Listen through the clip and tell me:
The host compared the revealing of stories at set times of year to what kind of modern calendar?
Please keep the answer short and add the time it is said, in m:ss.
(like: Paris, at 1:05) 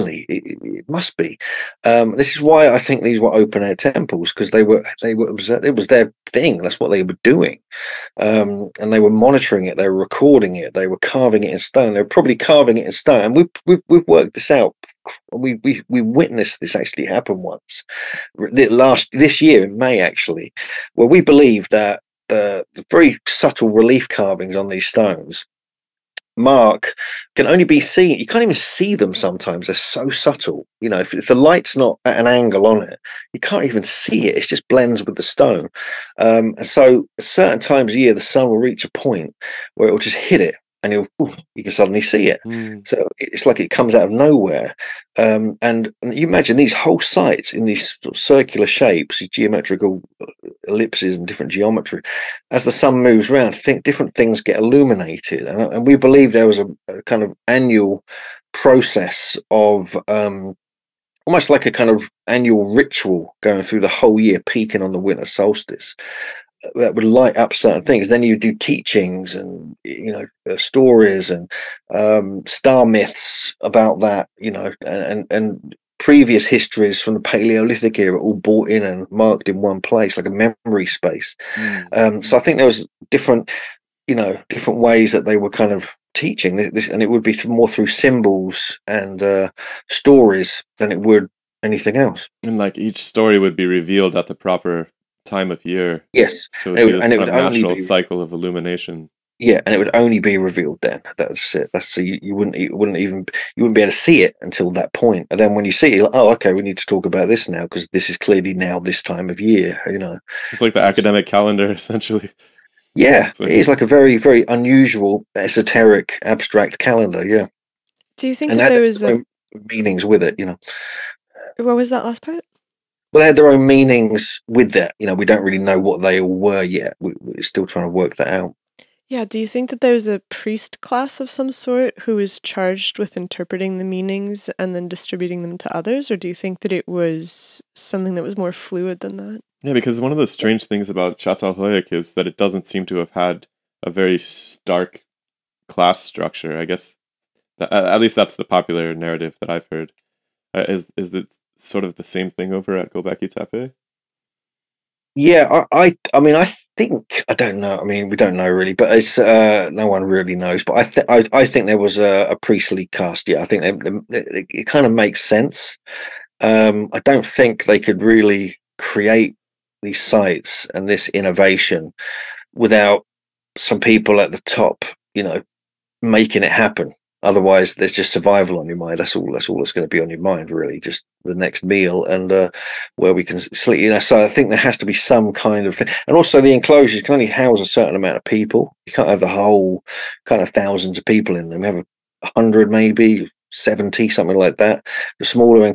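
Academic calendar, at 1:50.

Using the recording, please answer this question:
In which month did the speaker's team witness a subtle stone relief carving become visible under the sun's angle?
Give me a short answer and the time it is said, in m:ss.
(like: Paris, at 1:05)
May, at 0:19.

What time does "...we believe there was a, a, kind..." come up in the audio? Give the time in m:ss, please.
0:55.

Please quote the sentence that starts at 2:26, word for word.
I guess, at least that's the popular narrative that I've heard.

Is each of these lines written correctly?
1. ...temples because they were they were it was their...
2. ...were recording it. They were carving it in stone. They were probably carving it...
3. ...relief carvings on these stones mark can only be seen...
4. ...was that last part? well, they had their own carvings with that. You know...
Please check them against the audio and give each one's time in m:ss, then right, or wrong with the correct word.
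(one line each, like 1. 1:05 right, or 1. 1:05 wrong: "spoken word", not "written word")
1. 0:03 right
2. 0:09 right
3. 0:23 right
4. 2:01 wrong: "meanings", not "carvings".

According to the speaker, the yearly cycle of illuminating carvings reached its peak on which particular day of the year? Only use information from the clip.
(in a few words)
Winter solstice.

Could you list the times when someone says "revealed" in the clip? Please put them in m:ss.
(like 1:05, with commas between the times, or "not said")
1:33, 1:40.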